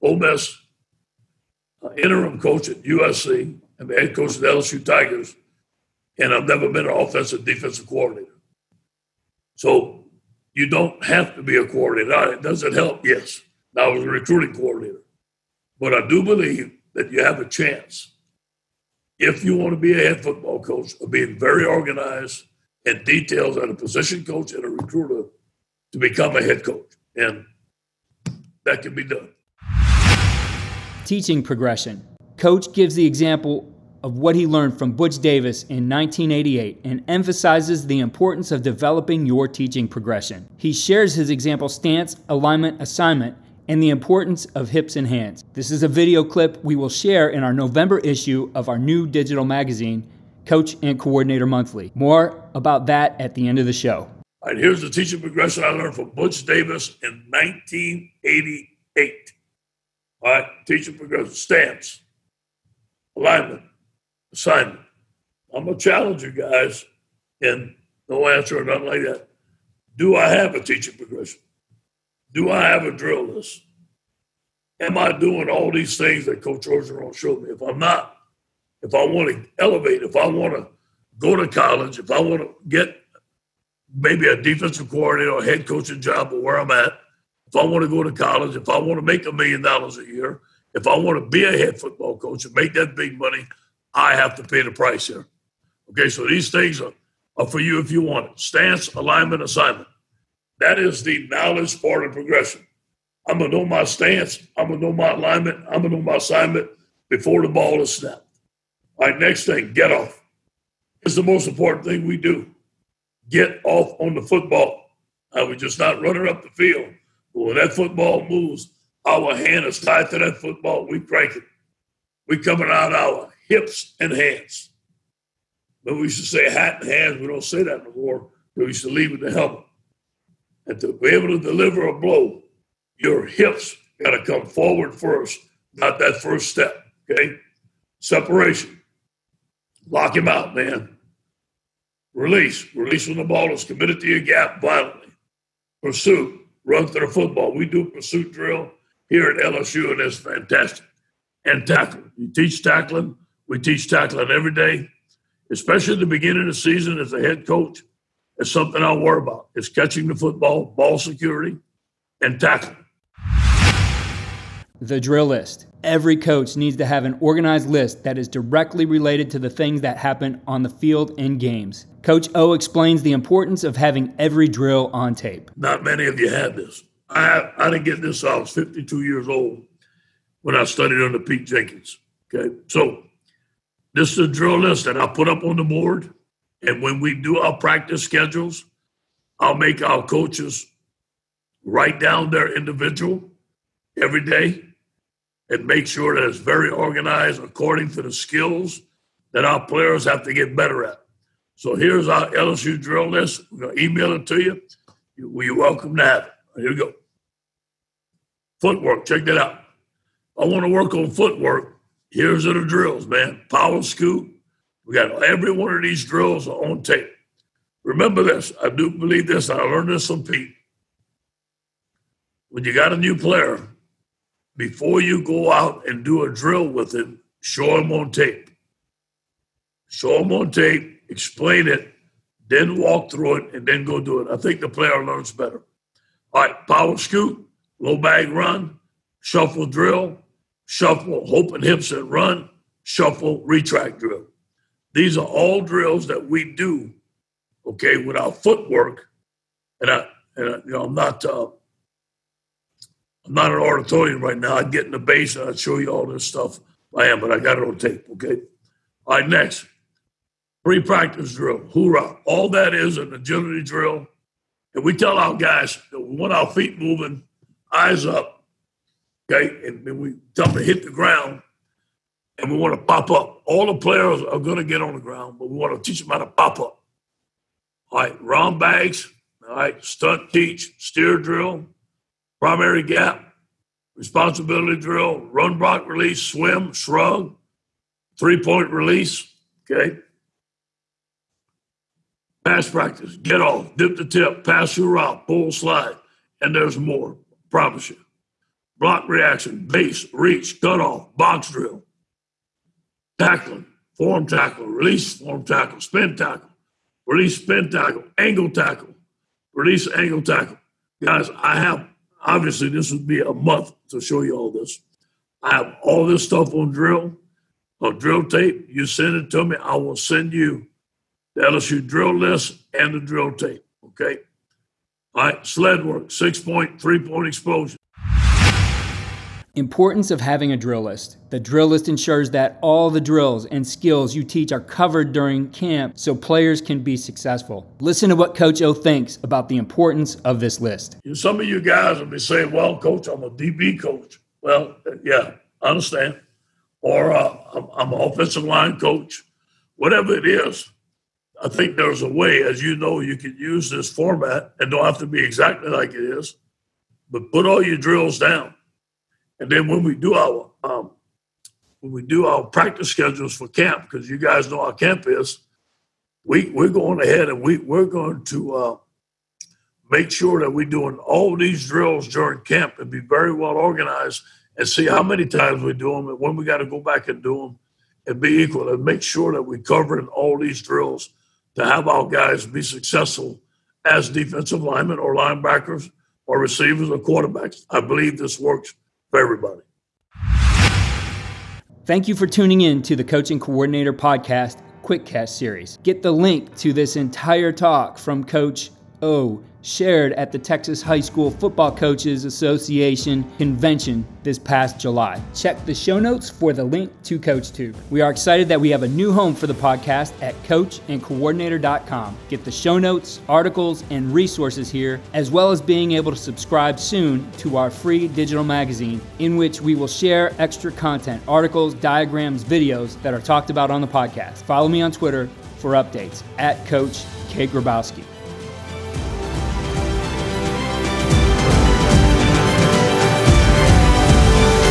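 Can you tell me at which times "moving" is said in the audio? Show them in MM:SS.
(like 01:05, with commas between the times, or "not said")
04:26.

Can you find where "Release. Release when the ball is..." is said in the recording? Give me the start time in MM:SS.
02:22.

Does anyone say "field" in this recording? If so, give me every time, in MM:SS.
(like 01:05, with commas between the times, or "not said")
01:56, 02:50.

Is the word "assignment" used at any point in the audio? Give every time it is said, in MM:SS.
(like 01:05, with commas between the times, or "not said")
00:42, 01:04, 01:39, 01:46.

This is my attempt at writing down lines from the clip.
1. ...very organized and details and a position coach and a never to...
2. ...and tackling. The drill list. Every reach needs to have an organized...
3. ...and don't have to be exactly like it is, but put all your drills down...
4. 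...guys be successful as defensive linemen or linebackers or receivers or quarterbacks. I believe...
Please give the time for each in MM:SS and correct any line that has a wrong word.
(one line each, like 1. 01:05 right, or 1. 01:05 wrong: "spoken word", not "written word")
1. 00:21 wrong: "recruiter", not "never"
2. 02:42 wrong: "coach", not "reach"
3. 05:54 right
4. 06:22 right.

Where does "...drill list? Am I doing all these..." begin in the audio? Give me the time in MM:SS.
01:12.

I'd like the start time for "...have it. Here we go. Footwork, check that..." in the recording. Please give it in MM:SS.
03:26.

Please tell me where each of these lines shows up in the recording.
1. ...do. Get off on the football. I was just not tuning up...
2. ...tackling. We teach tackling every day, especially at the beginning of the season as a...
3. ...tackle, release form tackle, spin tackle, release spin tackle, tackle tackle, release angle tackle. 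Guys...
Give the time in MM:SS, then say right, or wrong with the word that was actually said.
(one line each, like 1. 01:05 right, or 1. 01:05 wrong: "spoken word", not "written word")
1. 01:52 wrong: "running", not "tuning"
2. 02:32 right
3. 05:04 wrong: "angle", not "tackle".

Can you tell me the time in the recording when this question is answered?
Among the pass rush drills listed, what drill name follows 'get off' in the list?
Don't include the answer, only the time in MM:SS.
04:53.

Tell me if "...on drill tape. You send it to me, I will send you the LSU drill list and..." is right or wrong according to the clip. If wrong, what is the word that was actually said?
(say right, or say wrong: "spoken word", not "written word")
right.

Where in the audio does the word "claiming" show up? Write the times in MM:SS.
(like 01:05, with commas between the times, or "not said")
not said.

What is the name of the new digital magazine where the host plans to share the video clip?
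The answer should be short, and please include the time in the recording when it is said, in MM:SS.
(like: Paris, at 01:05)
Coach and Coordinator Monthly, at 00:50.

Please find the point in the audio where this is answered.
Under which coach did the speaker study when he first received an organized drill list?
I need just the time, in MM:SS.
03:01.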